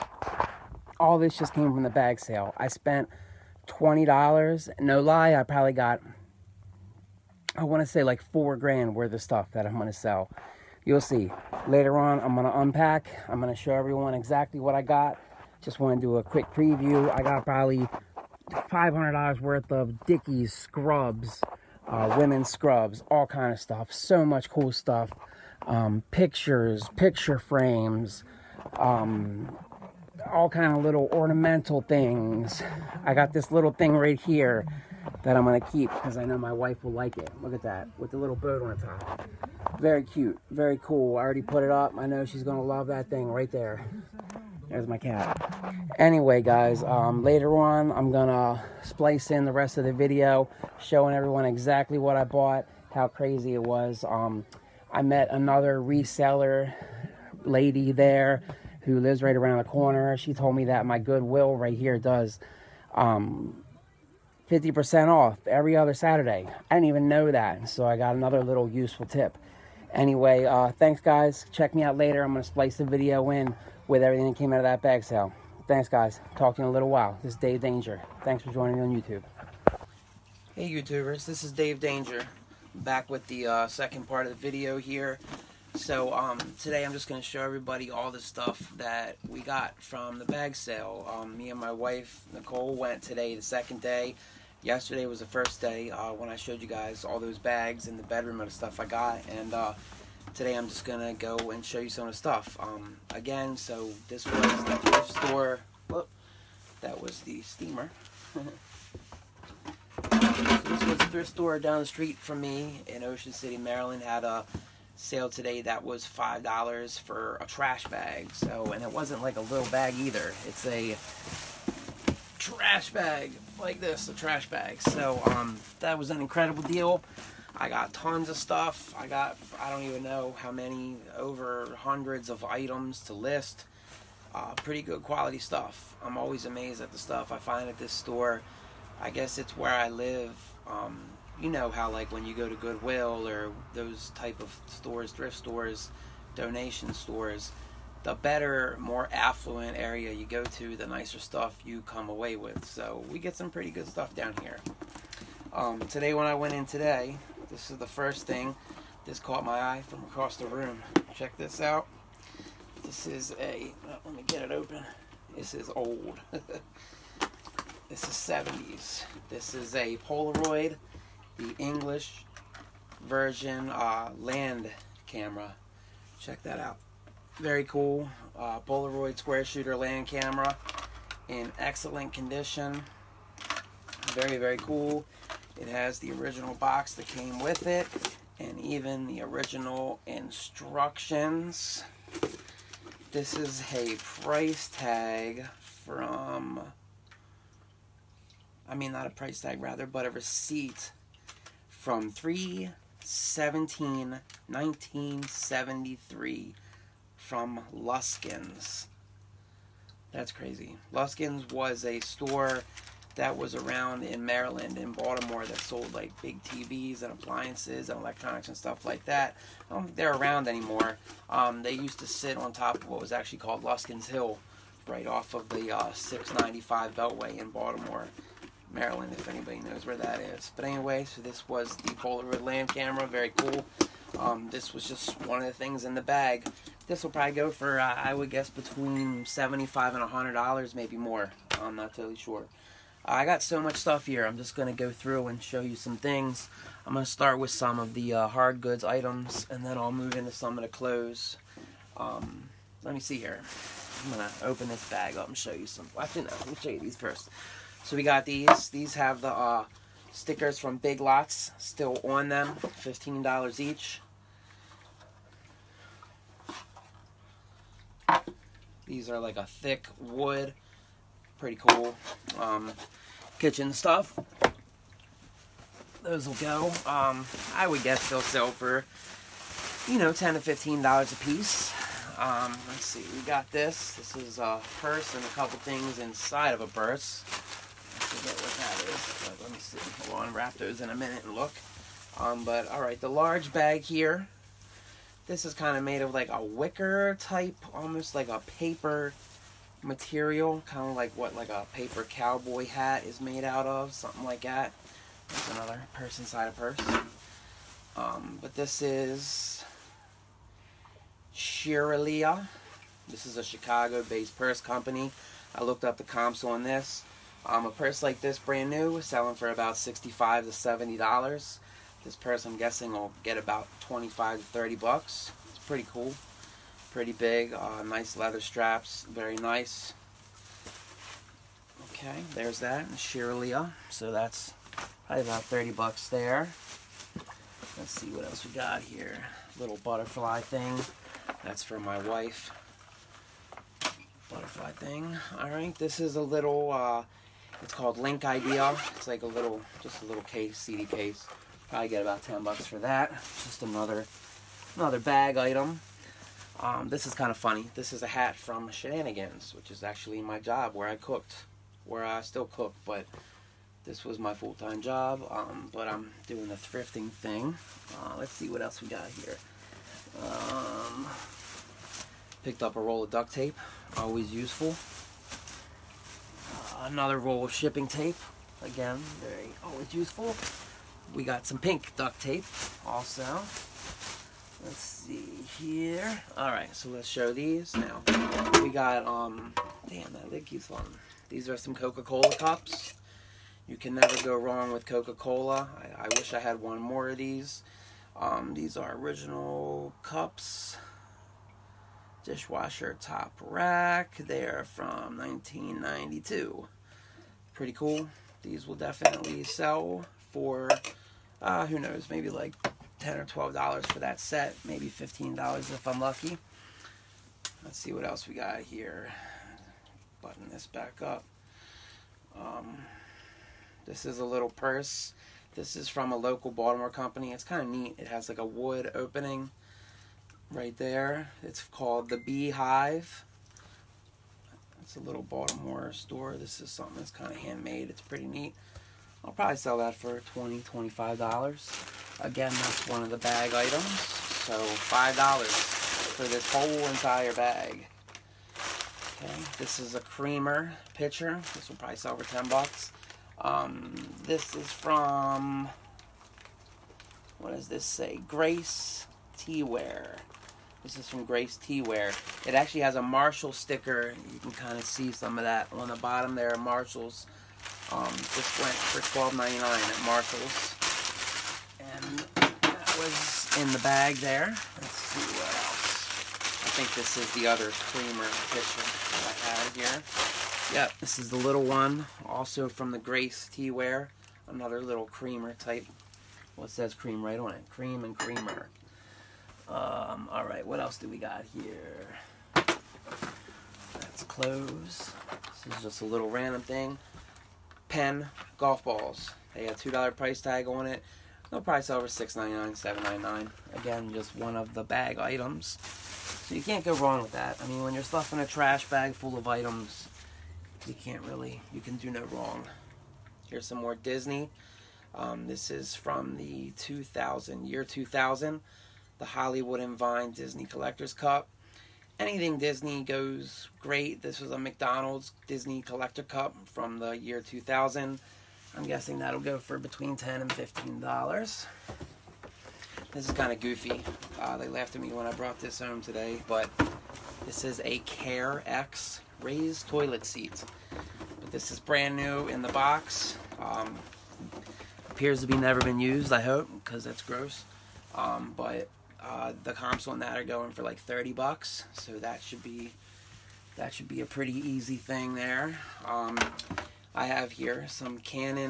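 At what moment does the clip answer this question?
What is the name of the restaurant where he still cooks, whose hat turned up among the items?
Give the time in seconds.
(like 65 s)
358 s.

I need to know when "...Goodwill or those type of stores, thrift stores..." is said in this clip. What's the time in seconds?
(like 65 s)
142 s.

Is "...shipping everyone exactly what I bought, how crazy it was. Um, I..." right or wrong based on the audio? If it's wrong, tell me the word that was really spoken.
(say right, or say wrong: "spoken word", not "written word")
wrong: "showing", not "shipping".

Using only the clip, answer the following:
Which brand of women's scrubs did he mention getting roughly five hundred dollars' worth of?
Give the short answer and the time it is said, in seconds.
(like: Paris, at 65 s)
Dickies, at 20 s.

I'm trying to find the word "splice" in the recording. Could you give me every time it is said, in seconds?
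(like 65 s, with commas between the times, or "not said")
48 s, 72 s.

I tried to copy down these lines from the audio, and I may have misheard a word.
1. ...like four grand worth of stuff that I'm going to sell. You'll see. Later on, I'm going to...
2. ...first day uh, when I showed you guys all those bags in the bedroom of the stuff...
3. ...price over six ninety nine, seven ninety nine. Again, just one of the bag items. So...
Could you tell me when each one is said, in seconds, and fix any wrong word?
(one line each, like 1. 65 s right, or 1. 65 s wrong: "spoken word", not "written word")
1. 8 s right
2. 95 s right
3. 501 s right.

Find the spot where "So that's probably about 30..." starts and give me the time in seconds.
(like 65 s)
333 s.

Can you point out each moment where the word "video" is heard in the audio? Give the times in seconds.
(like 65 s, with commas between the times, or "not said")
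49 s, 72 s, 84 s.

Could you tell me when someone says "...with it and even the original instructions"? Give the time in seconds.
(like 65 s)
187 s.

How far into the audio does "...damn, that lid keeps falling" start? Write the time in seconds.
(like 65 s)
389 s.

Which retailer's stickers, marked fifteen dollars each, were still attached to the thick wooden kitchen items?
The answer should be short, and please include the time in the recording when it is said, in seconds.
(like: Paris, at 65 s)
Big Lots, at 260 s.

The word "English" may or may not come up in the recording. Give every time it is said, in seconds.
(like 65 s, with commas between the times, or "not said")
171 s.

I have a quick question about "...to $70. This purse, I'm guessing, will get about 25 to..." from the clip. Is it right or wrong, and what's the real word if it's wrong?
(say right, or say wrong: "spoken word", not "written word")
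right.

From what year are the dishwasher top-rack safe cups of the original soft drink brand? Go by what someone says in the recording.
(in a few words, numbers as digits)
1992.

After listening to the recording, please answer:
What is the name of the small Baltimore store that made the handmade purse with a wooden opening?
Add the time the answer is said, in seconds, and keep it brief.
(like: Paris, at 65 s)
The Beehive, at 432 s.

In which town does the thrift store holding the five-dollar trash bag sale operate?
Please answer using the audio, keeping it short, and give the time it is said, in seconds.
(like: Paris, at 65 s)
Ocean City, Maryland, at 113 s.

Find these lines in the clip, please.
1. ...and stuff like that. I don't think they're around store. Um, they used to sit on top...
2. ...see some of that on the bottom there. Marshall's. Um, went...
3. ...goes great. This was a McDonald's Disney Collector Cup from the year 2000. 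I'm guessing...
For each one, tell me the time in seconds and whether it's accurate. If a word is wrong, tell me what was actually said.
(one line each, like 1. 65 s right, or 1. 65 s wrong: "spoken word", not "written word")
1. 218 s wrong: "anymore", not "store"
2. 464 s right
3. 523 s right.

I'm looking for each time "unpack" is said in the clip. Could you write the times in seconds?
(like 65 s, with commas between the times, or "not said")
12 s.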